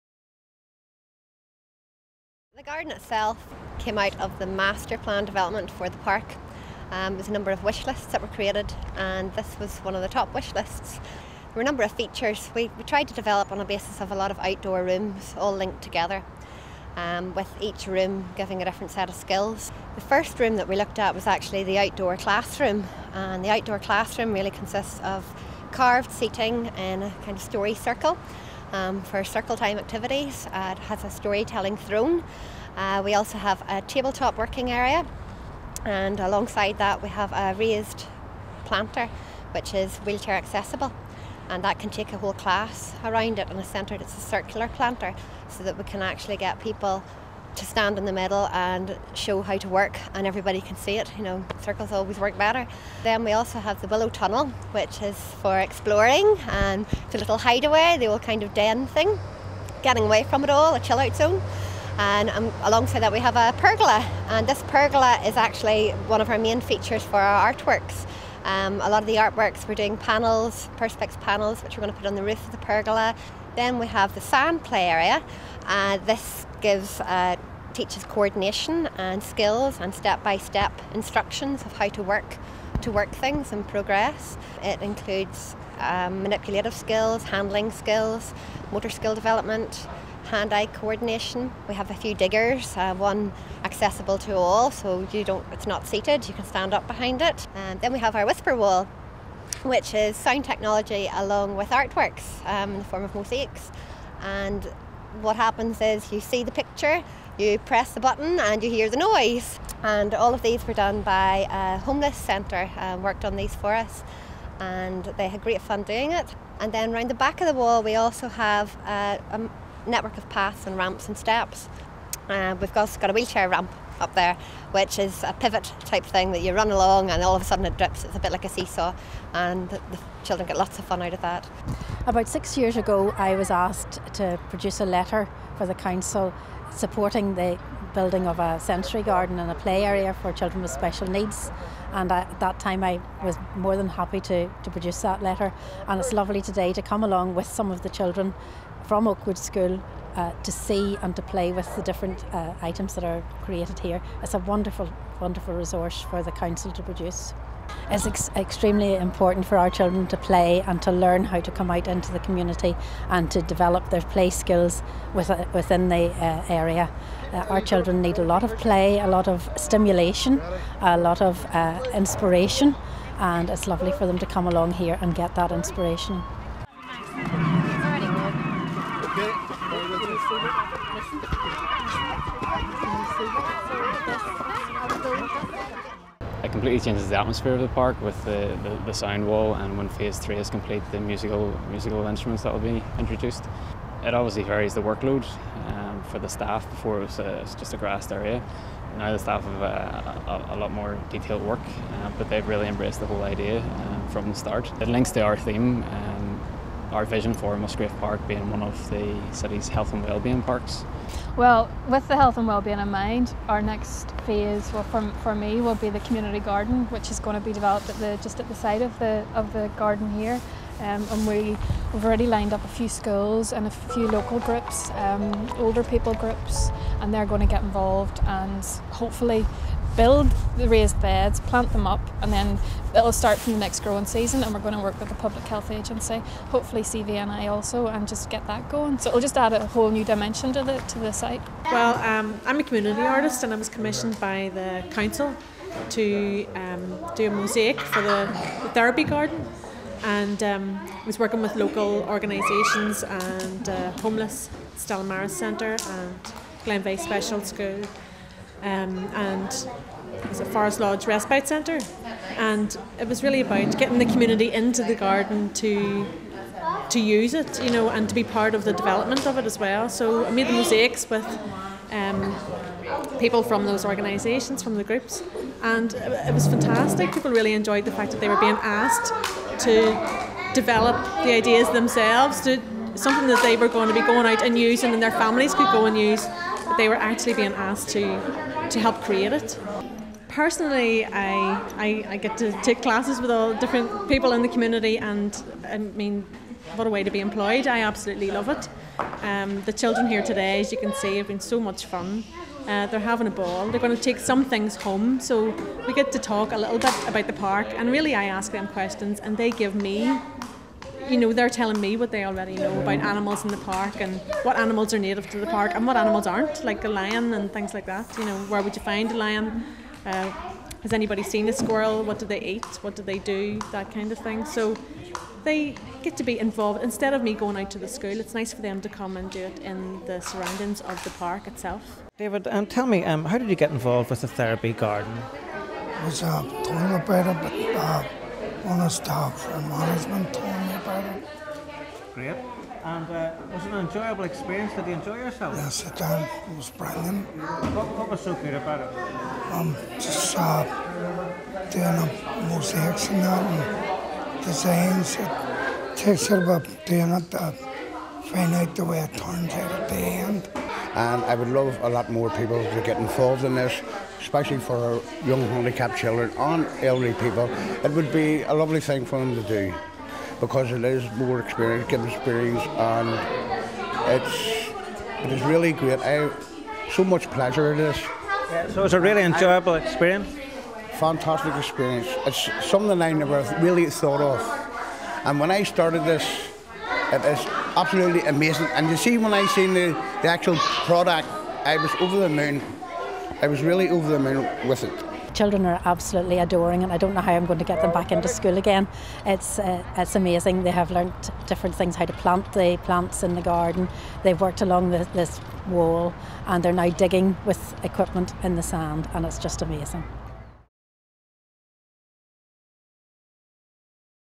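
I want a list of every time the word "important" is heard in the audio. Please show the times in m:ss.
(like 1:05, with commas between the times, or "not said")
2:38.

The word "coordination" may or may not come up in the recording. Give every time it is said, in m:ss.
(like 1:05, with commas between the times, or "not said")
1:18, 1:30.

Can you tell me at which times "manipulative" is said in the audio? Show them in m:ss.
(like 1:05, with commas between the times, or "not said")
1:26.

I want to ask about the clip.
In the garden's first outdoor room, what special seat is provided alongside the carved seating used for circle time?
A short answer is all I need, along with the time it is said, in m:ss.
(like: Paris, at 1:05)
storytelling throne, at 0:31.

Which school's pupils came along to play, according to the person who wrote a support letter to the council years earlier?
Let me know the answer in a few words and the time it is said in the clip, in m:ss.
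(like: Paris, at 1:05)
Oakwood School, at 2:29.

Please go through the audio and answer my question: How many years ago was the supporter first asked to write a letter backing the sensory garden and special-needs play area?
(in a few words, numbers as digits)
6.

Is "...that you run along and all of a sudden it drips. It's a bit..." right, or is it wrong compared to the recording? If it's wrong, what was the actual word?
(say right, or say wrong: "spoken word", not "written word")
right.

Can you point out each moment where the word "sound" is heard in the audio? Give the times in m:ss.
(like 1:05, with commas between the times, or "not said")
1:40, 3:08.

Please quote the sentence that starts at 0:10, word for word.
There were a number of features.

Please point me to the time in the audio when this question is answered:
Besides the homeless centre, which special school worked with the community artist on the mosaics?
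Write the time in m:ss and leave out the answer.
4:16.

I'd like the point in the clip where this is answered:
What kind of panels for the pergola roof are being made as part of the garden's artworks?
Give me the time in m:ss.
1:10.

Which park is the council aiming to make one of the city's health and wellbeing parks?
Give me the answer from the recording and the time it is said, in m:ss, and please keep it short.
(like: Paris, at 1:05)
Musgrave Park, at 3:27.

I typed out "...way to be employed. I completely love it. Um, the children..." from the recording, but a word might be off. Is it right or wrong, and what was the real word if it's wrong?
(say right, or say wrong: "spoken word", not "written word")
wrong: "absolutely", not "completely".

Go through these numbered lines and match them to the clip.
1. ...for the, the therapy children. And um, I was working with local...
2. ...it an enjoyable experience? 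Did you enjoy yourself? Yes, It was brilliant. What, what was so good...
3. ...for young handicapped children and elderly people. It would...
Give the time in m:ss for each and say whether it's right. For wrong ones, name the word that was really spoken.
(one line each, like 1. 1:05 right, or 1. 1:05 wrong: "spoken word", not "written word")
1. 4:07 wrong: "garden", not "children"
2. 5:43 right
3. 6:04 right.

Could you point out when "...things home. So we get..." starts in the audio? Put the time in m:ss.
5:04.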